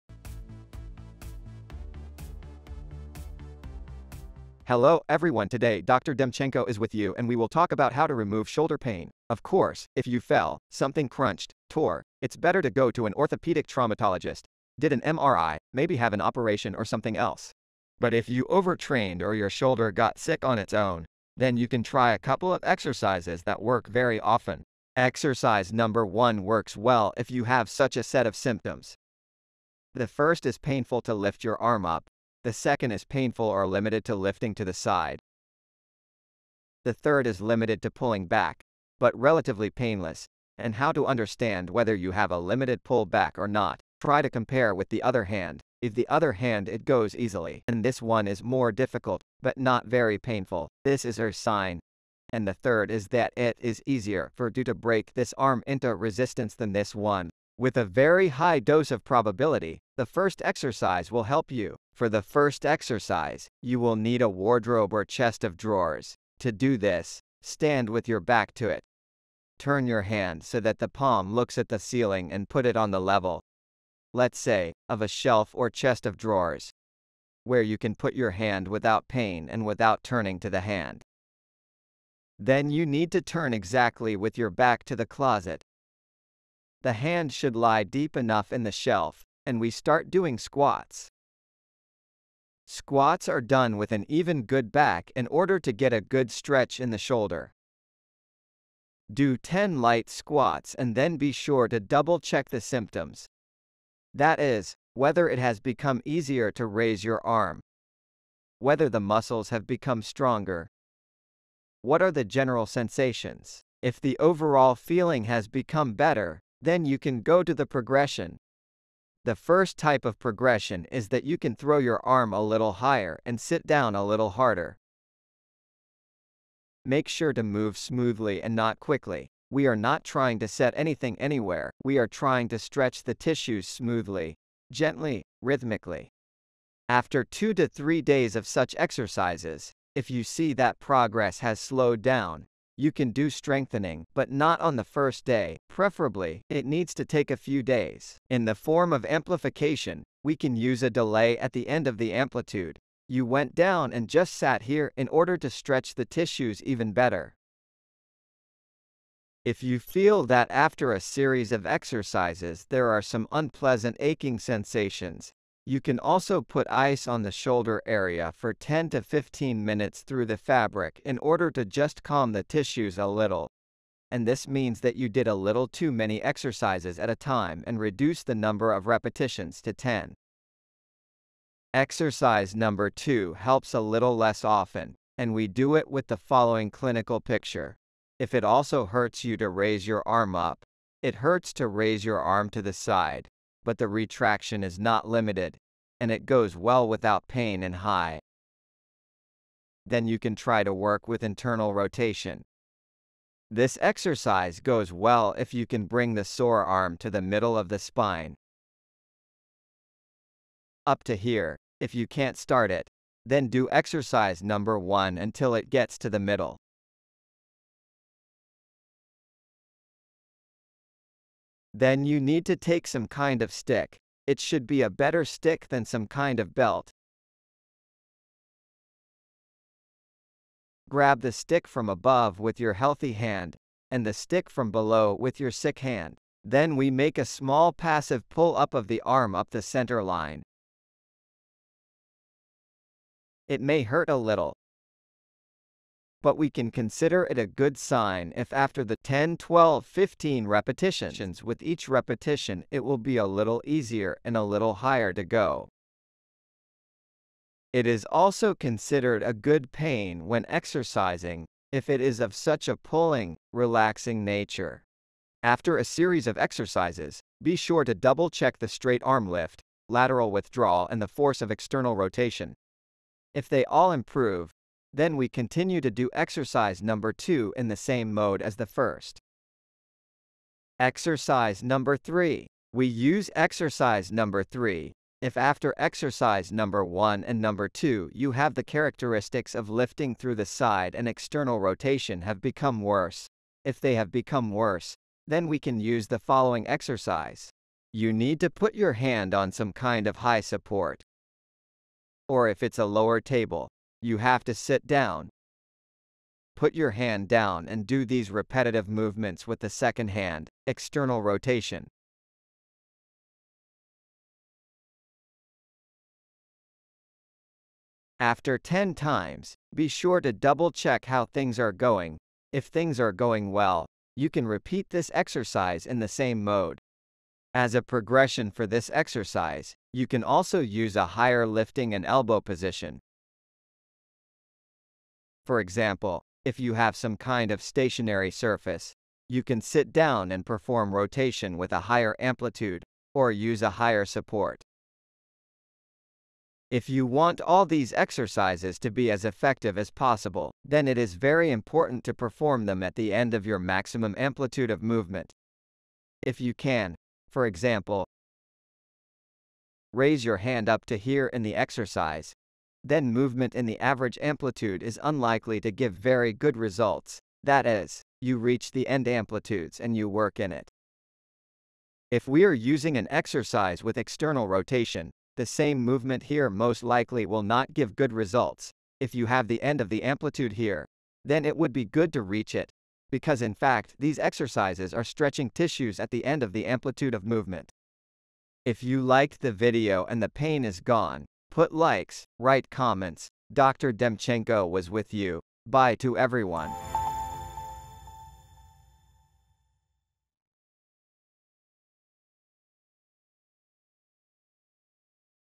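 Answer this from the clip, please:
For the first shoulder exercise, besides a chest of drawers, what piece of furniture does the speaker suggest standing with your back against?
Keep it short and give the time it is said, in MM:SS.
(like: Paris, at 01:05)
wardrobe, at 01:04.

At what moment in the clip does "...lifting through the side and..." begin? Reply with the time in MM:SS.
04:49.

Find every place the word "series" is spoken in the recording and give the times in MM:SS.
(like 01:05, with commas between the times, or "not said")
02:41, 04:25.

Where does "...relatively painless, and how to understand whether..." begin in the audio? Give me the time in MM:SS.
00:39.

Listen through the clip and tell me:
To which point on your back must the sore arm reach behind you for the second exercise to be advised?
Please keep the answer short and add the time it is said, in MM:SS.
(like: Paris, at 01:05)
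middle of the spine, at 03:27.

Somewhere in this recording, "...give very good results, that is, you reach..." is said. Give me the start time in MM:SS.
06:05.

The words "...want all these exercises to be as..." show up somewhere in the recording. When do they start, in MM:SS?
05:47.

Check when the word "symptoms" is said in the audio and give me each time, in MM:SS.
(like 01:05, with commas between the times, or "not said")
00:28, 01:42.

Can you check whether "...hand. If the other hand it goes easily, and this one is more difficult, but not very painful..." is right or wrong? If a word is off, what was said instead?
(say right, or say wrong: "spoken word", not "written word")
right.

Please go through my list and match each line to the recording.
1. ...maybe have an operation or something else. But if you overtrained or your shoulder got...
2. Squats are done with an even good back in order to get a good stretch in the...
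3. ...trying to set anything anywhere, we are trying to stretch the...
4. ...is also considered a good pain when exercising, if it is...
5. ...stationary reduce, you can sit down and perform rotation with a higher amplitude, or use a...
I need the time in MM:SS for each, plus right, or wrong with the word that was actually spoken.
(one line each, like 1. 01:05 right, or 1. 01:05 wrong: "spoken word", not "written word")
1. 00:15 right
2. 01:32 right
3. 02:10 right
4. 04:17 right
5. 05:37 wrong: "surface", not "reduce".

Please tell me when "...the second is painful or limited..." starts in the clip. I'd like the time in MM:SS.
00:32.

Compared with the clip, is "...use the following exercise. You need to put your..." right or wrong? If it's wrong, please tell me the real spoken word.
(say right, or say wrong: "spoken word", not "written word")
right.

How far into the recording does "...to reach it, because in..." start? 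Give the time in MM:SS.
06:22.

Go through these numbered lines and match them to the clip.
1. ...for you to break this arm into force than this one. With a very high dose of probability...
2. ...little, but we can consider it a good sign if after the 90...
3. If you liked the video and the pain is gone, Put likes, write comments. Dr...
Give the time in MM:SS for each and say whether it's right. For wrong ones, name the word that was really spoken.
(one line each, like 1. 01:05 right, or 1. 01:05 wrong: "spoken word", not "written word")
1. 00:54 wrong: "resistance", not "force"
2. 04:04 wrong: "10", not "90"
3. 06:28 right.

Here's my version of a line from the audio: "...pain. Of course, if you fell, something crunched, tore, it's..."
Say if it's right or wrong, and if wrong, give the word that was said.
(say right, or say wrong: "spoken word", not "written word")
right.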